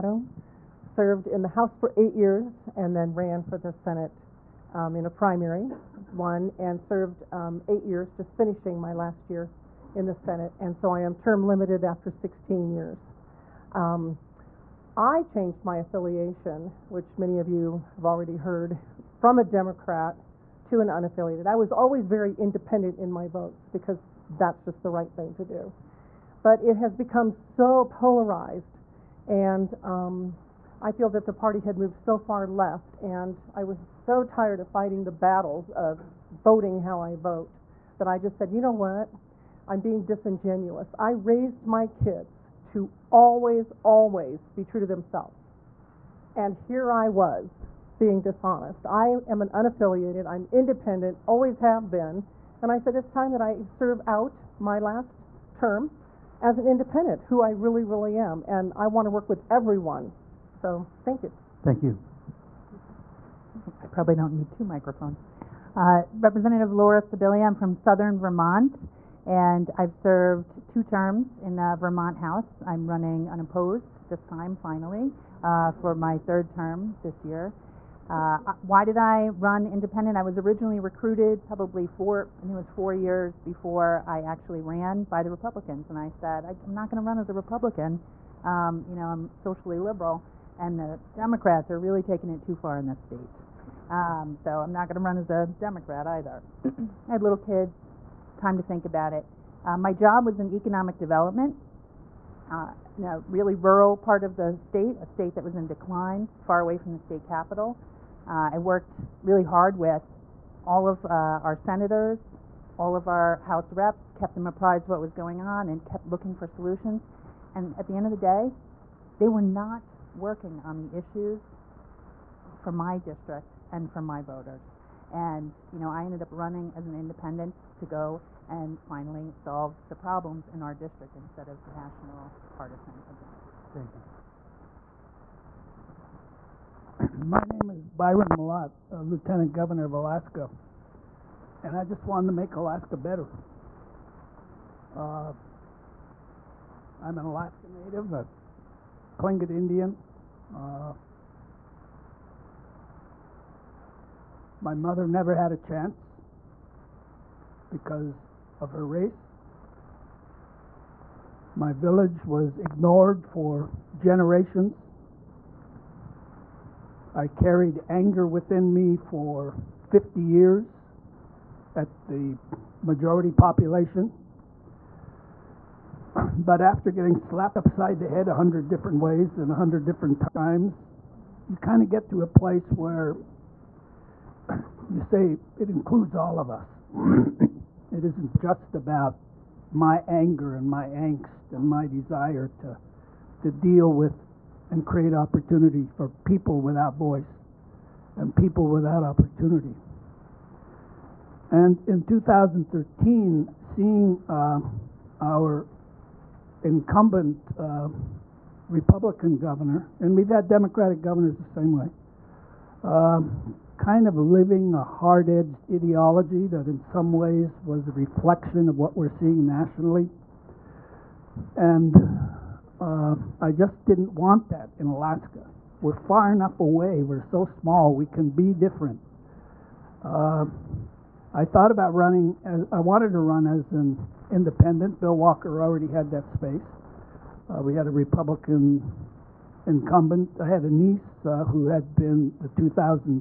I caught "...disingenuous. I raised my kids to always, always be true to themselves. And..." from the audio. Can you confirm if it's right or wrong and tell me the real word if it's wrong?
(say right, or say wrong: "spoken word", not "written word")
right.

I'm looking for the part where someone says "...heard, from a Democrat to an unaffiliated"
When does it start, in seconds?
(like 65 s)
18 s.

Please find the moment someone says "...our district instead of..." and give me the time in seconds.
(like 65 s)
130 s.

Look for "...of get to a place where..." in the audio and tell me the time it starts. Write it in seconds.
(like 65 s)
181 s.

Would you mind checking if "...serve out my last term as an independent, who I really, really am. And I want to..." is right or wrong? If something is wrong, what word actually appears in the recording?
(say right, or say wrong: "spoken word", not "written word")
right.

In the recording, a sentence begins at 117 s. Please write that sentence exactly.
And at the end of the day, they were not working on the issues for my district and for my voters.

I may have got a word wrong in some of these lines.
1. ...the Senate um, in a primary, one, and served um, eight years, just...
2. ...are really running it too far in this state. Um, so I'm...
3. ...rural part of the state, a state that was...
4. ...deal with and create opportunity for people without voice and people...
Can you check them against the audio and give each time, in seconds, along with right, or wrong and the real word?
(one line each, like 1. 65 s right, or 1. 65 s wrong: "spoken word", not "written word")
1. 3 s right
2. 91 s wrong: "taking", not "running"
3. 103 s right
4. 193 s right.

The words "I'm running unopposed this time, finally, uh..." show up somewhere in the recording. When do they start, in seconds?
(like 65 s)
72 s.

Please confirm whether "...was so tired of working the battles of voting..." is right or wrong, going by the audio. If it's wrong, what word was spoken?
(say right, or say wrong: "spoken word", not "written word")
wrong: "fighting", not "working".